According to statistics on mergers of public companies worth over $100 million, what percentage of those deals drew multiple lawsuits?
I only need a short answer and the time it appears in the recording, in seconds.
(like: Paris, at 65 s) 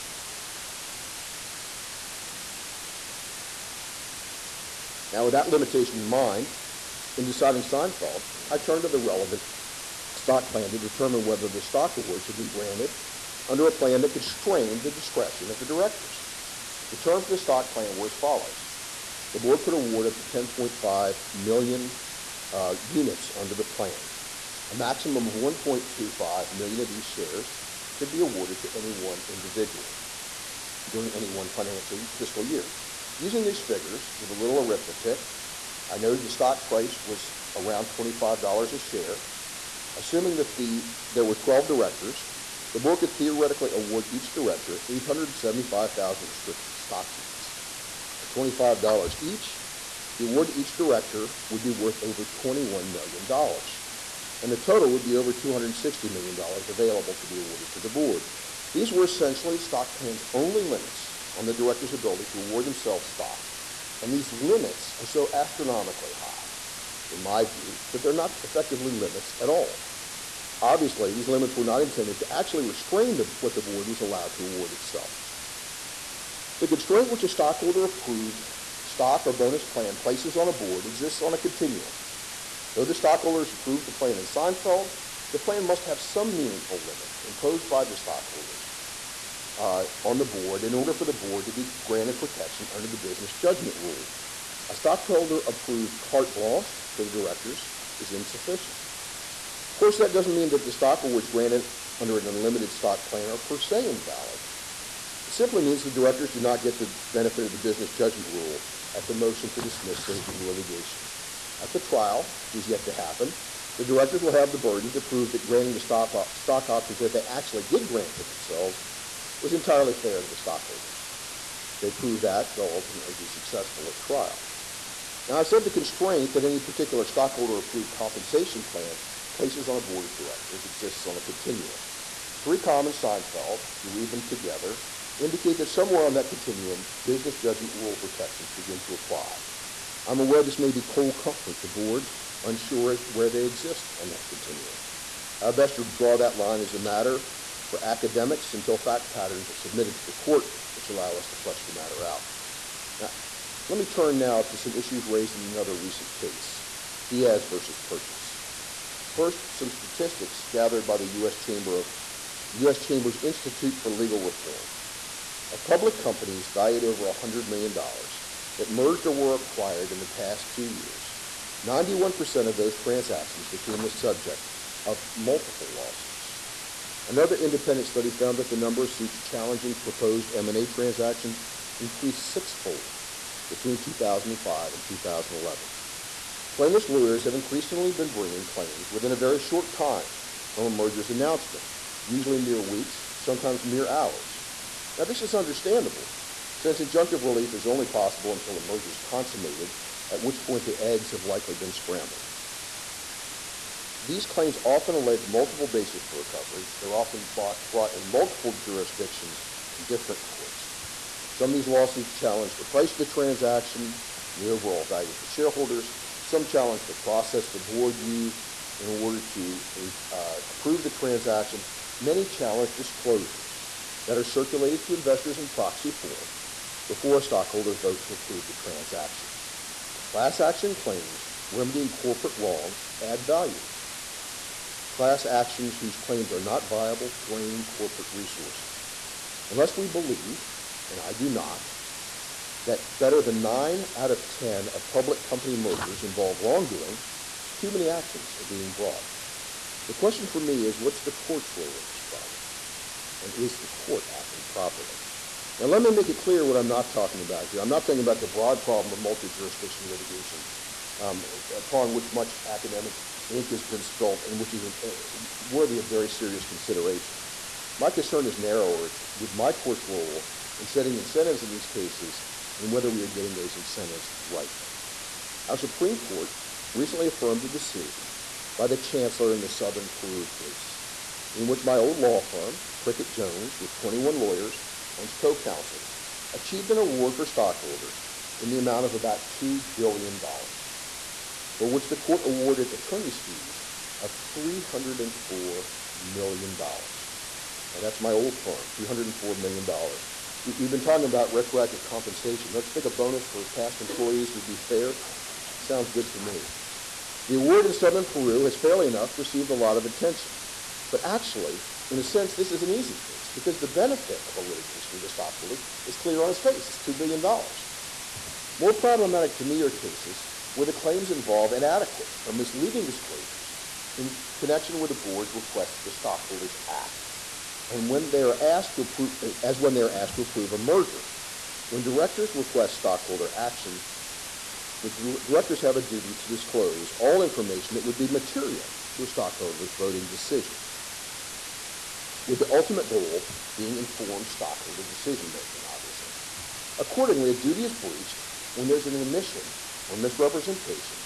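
91%, at 171 s.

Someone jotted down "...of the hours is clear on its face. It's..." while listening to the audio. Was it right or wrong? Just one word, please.
wrong.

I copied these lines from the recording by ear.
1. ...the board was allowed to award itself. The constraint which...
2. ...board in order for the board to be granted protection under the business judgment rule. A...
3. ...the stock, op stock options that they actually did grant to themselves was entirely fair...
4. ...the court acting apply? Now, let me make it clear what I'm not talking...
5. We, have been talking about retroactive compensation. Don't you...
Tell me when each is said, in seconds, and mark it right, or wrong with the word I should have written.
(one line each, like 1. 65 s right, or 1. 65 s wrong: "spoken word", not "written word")
1. 73 s right
2. 90 s right
3. 115 s right
4. 253 s wrong: "properly", not "apply"
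5. 300 s right.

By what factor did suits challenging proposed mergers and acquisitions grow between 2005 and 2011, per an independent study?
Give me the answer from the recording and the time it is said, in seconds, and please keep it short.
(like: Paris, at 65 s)
sixfold, at 182 s.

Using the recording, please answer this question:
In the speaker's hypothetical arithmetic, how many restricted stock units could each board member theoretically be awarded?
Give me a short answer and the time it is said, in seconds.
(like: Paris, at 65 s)
875,000, at 44 s.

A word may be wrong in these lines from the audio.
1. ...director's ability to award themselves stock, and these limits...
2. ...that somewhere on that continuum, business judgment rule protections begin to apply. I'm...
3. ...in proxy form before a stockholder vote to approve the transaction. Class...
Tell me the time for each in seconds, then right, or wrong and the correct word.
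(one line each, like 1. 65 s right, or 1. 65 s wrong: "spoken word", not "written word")
1. 61 s right
2. 135 s right
3. 225 s right.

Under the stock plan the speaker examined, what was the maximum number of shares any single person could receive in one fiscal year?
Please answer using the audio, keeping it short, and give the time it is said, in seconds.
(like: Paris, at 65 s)
1.25 million, at 25 s.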